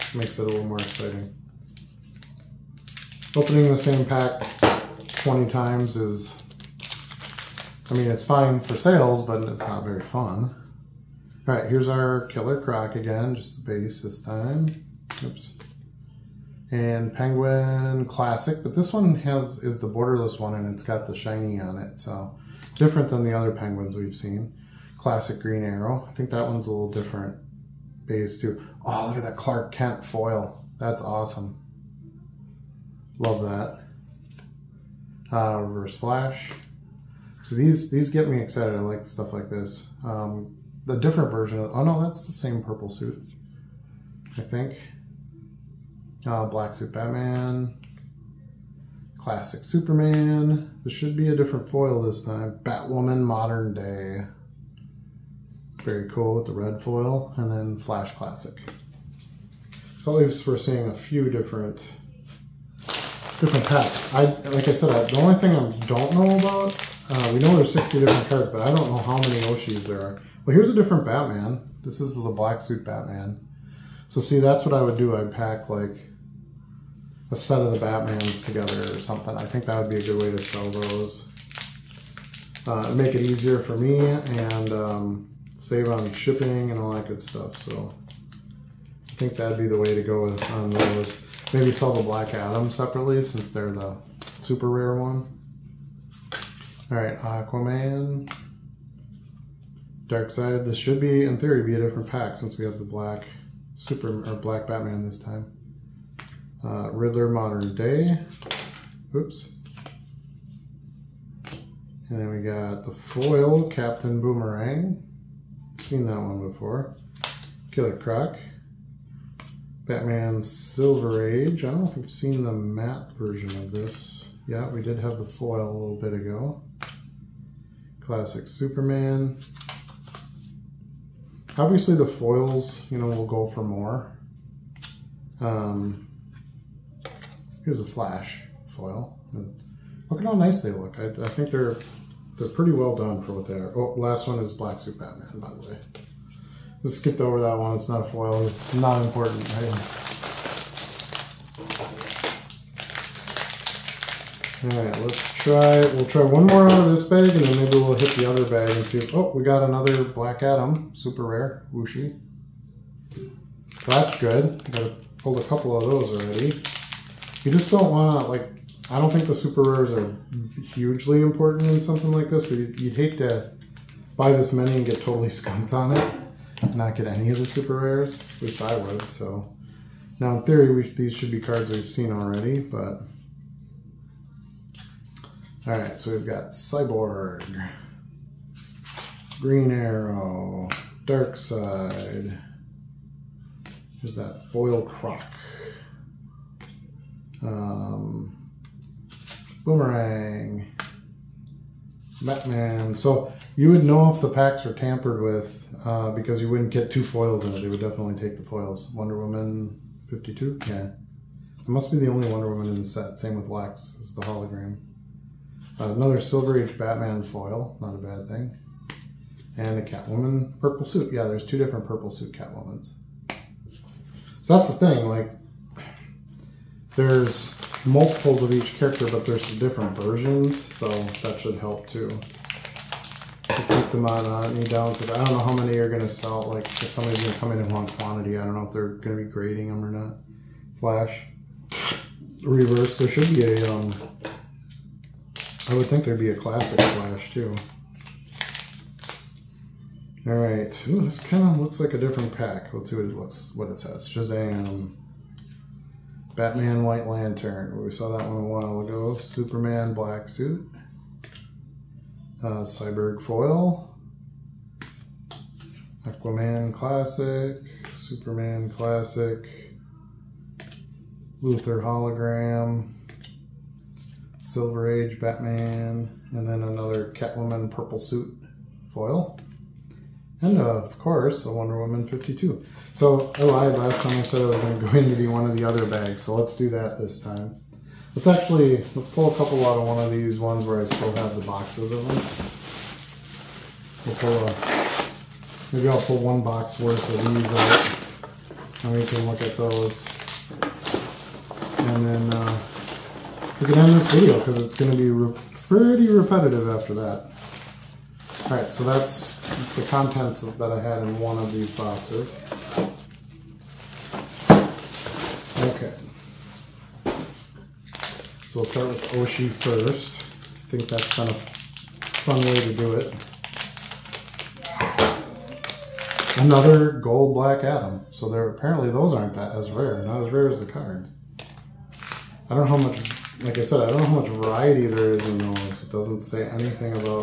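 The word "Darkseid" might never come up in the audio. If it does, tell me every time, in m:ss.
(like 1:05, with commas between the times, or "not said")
1:40, 3:11.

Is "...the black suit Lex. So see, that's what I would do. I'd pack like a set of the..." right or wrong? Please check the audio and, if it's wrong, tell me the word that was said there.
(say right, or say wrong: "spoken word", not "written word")
wrong: "Batman", not "Lex".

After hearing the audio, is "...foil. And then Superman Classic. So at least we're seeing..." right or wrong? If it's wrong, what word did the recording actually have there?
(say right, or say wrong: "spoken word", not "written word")
wrong: "Flash", not "Superman".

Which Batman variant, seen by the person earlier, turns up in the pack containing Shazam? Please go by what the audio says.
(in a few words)
White Lantern.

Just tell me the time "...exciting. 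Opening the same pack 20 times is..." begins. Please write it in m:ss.
0:00.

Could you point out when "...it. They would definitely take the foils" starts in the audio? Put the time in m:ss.
3:27.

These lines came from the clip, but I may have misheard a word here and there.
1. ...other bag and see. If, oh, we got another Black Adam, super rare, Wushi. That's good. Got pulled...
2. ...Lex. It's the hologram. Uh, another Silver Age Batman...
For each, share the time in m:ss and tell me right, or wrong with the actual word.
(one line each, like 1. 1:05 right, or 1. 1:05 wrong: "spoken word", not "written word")
1. 2:38 right
2. 3:33 right.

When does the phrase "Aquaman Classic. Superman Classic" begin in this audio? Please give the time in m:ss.
4:26.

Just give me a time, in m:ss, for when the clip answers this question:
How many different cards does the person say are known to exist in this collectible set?
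1:07.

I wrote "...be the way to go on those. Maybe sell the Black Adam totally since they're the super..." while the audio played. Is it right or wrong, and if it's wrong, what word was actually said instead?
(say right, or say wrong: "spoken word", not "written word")
wrong: "separately", not "totally".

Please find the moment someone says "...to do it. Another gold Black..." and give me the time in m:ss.
5:22.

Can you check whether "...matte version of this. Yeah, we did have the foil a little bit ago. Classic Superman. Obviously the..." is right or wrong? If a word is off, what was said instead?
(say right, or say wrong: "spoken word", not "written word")
right.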